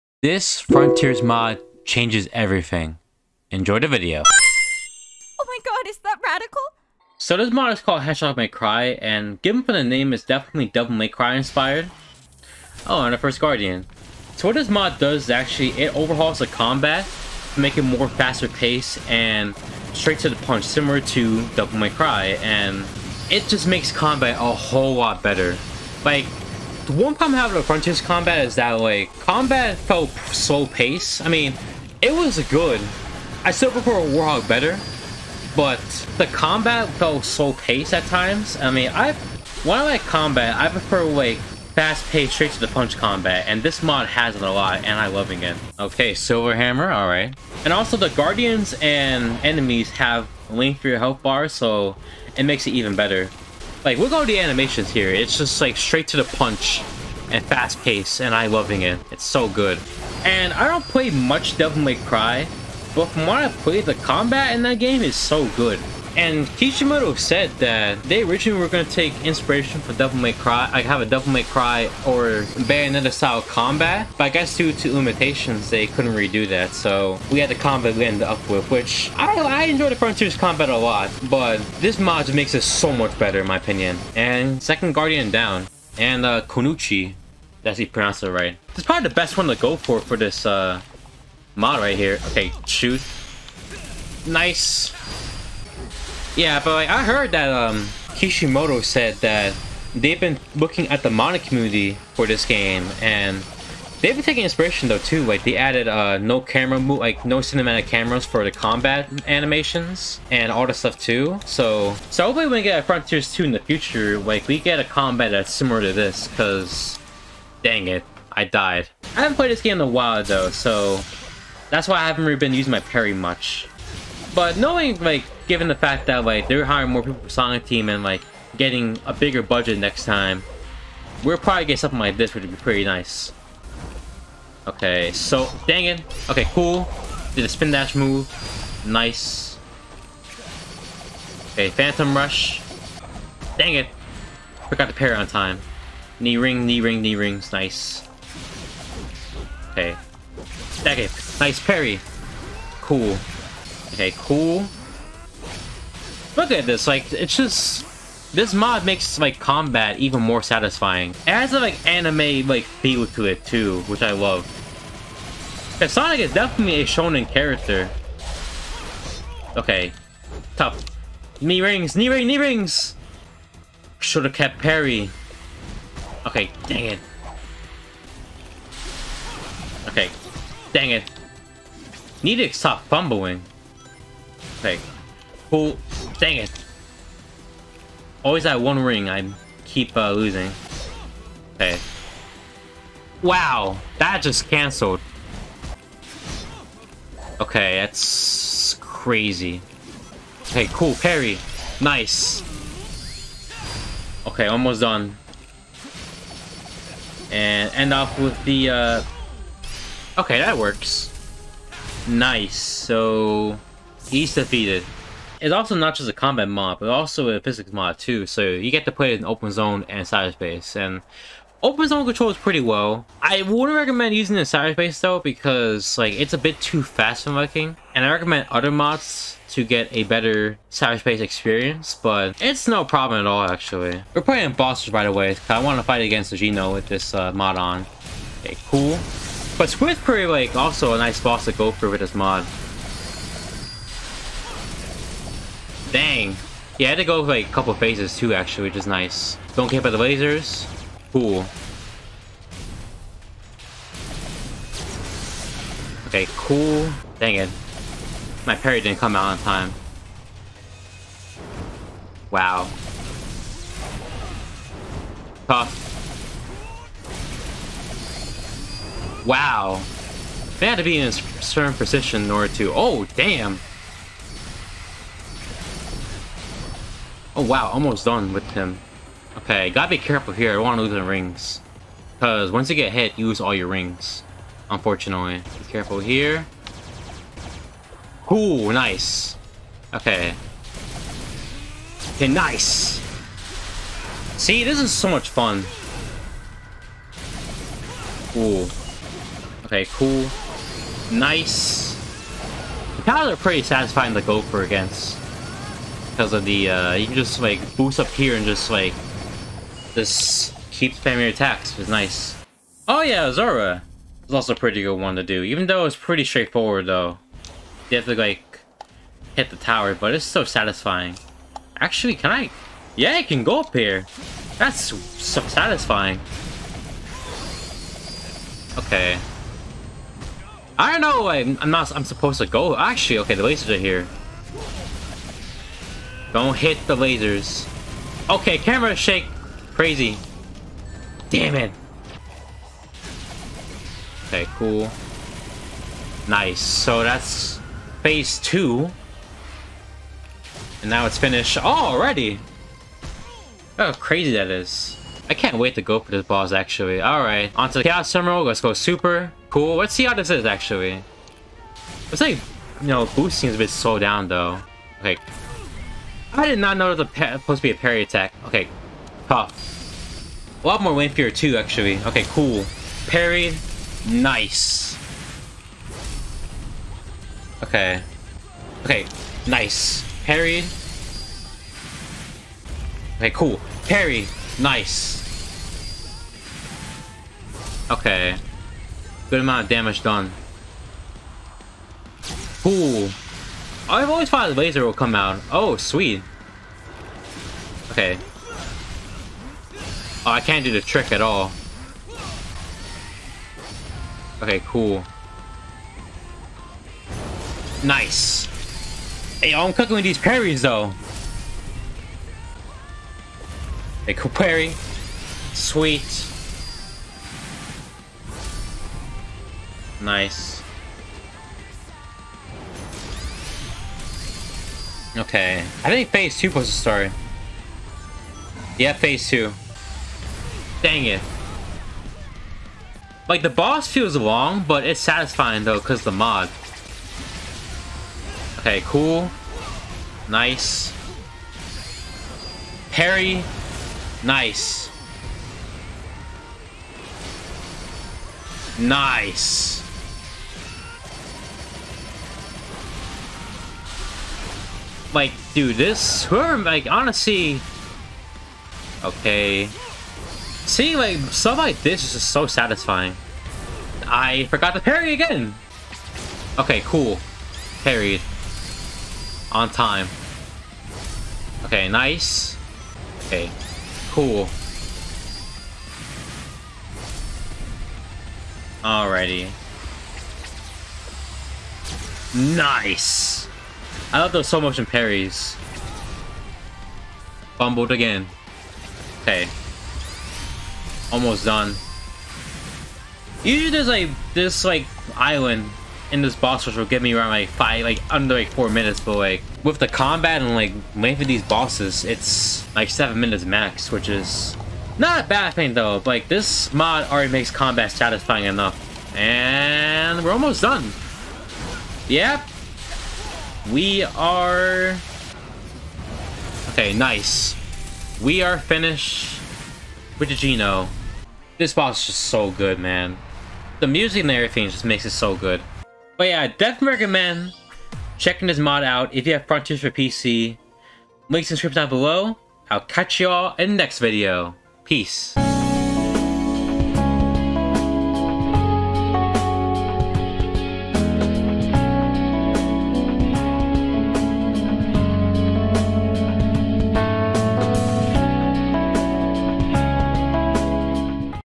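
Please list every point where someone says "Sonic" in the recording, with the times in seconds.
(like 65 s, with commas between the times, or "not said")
127 s, 165 s.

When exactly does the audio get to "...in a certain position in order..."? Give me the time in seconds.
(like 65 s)
270 s.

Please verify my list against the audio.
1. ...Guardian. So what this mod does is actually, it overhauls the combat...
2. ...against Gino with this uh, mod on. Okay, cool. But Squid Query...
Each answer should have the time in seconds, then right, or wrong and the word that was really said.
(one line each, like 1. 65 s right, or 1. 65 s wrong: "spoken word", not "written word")
1. 13 s right
2. 236 s right.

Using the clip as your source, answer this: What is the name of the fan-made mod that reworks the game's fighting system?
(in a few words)
Hedgehog May Cry.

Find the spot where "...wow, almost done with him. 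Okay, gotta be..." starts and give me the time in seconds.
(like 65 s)
277 s.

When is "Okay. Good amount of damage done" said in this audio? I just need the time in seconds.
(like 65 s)
387 s.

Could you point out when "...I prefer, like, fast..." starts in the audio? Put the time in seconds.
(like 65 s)
40 s.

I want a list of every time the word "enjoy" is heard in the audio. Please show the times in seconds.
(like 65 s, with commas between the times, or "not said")
3 s, 79 s.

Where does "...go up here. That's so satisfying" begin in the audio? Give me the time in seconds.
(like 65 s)
323 s.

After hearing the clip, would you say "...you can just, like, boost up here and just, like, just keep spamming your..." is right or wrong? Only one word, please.
right.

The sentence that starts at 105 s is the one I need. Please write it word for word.
Like they added uh, no camera move, like no cinematic cameras for the combat animations and all the stuff too.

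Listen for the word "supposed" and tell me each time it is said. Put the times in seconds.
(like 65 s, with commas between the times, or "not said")
332 s, 367 s.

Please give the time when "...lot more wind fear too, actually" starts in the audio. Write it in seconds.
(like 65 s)
370 s.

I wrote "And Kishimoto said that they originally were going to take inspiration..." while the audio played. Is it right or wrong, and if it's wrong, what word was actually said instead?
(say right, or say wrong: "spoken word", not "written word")
right.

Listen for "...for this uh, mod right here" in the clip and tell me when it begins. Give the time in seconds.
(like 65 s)
90 s.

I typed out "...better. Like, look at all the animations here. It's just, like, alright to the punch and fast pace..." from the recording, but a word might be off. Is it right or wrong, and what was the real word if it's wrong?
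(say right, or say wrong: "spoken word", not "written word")
wrong: "straight", not "alright".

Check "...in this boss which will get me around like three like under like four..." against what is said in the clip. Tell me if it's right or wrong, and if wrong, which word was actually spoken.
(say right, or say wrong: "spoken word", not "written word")
wrong: "five", not "three".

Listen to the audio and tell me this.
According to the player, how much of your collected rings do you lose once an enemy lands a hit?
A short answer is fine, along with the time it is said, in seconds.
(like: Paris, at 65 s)
all your rings, at 283 s.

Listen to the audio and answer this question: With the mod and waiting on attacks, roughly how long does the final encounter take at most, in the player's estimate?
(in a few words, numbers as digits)
7 minutes.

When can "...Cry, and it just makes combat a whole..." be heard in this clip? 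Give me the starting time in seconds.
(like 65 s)
21 s.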